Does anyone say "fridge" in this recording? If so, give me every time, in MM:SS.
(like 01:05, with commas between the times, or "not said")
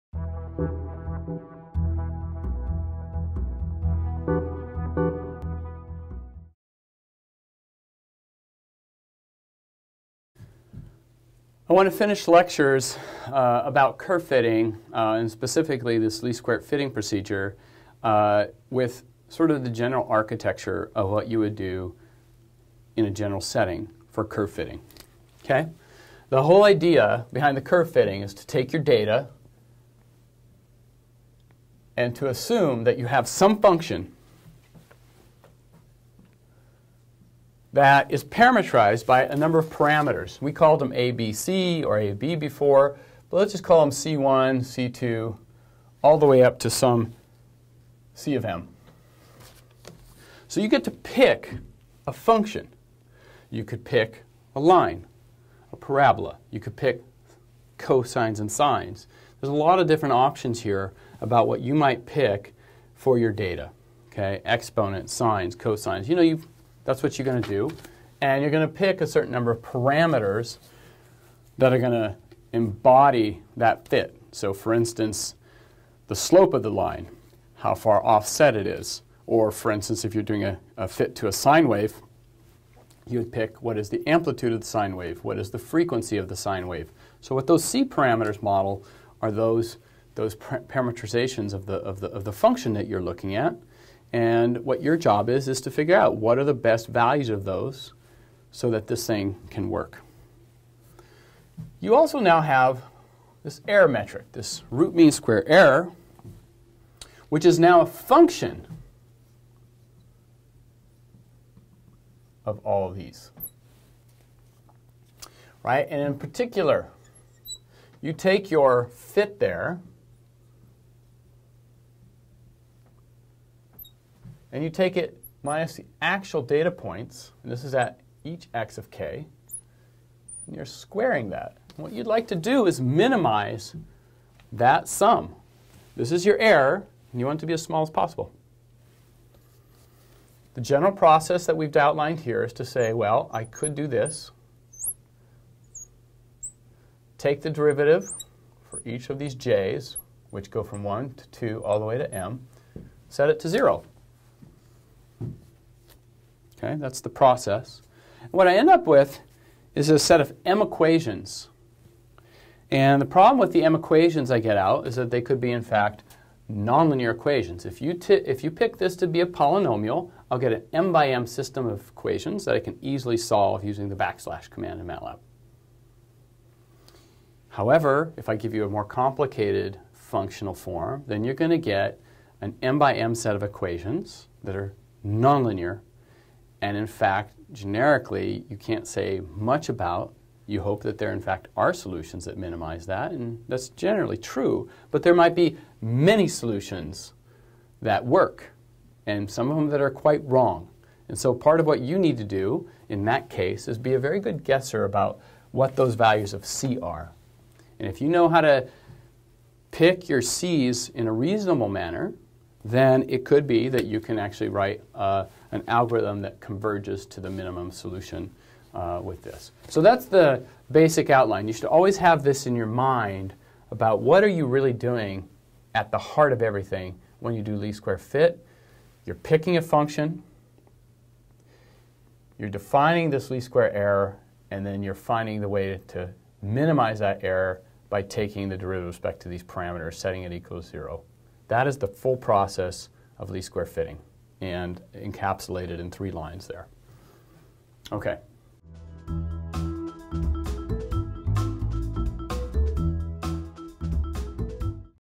not said.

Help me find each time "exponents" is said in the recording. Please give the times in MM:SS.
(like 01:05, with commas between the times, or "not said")
01:04.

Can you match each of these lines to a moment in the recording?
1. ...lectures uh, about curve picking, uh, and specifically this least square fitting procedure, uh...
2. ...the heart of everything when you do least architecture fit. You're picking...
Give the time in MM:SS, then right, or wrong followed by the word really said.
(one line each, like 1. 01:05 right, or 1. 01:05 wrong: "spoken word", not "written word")
1. 00:12 wrong: "fitting", not "picking"
2. 03:45 wrong: "square", not "architecture".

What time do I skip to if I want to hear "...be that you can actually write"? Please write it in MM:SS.
03:33.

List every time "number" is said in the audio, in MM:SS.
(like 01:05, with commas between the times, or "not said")
00:39, 01:09.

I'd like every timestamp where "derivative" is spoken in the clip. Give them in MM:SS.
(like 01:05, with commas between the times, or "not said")
02:27, 03:58.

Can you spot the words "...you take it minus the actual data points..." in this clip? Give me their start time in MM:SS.
02:04.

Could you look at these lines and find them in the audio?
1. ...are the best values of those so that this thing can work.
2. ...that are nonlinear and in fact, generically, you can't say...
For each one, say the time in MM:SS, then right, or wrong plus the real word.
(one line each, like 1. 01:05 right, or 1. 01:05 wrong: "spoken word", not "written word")
1. 01:36 right
2. 03:04 right.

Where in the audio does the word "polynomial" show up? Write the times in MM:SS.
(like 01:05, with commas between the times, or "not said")
02:49.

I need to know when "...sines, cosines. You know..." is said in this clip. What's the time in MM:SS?
01:05.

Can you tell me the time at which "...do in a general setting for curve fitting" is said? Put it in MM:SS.
00:21.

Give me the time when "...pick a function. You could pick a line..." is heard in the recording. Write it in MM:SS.
00:50.